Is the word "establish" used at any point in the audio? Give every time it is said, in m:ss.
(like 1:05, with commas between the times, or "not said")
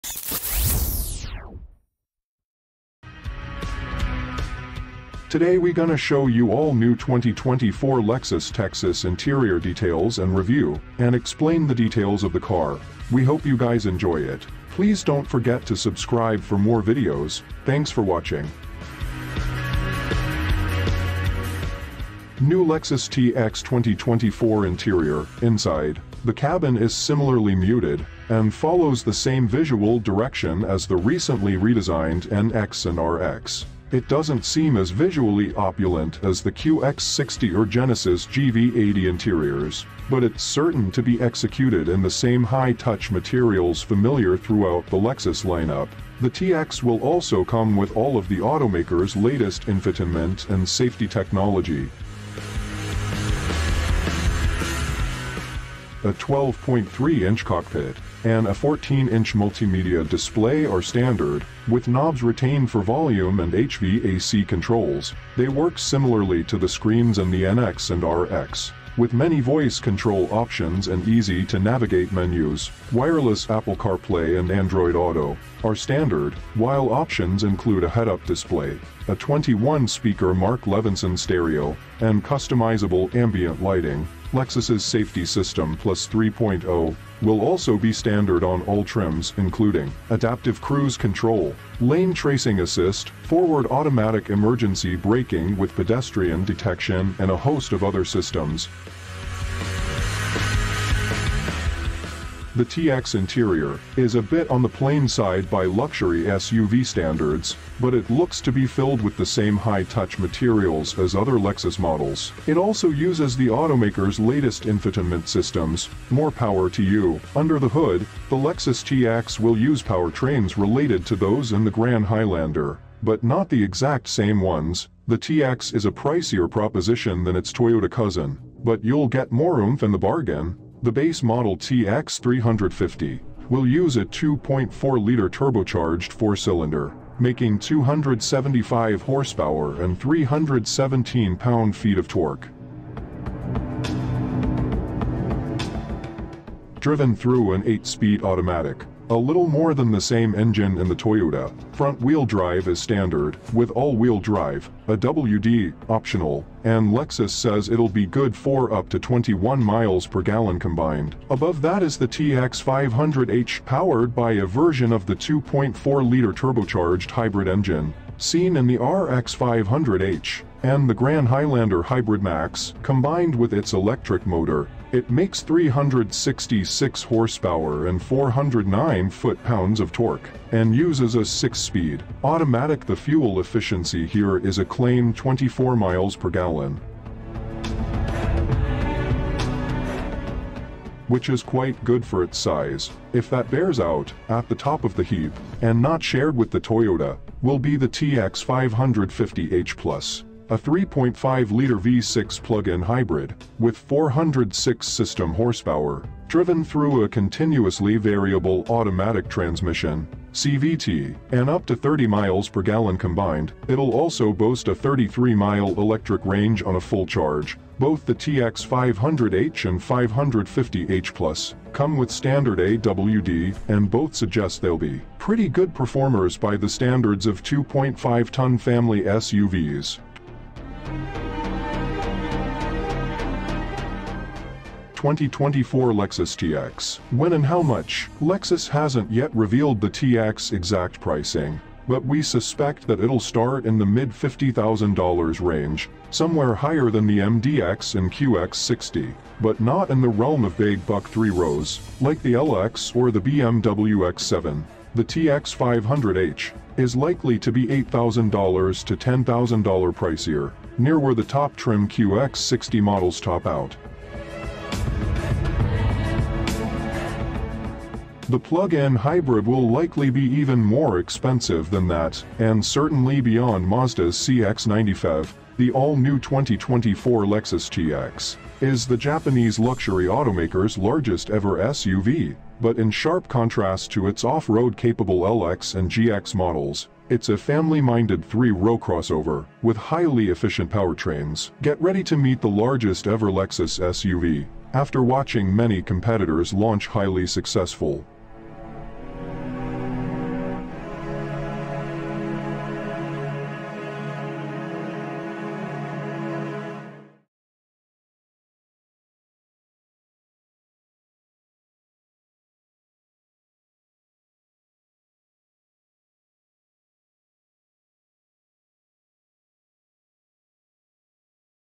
not said.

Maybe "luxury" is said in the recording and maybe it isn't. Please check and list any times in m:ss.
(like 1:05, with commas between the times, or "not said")
1:45, 4:39.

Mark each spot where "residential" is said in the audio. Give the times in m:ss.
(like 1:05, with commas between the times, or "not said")
not said.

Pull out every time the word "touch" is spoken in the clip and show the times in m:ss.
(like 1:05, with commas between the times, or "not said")
0:42, 1:49.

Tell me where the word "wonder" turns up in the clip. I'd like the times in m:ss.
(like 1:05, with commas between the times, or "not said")
not said.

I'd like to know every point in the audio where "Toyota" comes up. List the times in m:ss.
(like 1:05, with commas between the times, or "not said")
2:07, 2:30, 3:16.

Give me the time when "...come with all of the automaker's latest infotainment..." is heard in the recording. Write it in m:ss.
0:47.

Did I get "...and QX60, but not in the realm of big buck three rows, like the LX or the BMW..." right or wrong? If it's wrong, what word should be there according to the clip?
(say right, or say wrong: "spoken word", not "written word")
right.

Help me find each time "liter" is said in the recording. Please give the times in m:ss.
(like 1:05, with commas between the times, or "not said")
2:14, 2:45, 3:20.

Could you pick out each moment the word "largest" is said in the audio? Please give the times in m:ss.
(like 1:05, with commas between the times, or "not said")
4:40, 4:52.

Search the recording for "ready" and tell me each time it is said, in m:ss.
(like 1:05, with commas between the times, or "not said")
4:51.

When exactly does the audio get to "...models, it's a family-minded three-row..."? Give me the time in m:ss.
4:46.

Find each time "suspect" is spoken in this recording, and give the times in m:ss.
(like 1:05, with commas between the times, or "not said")
4:02.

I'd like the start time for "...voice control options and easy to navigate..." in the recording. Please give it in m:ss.
1:09.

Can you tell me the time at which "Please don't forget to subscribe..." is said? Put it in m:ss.
0:14.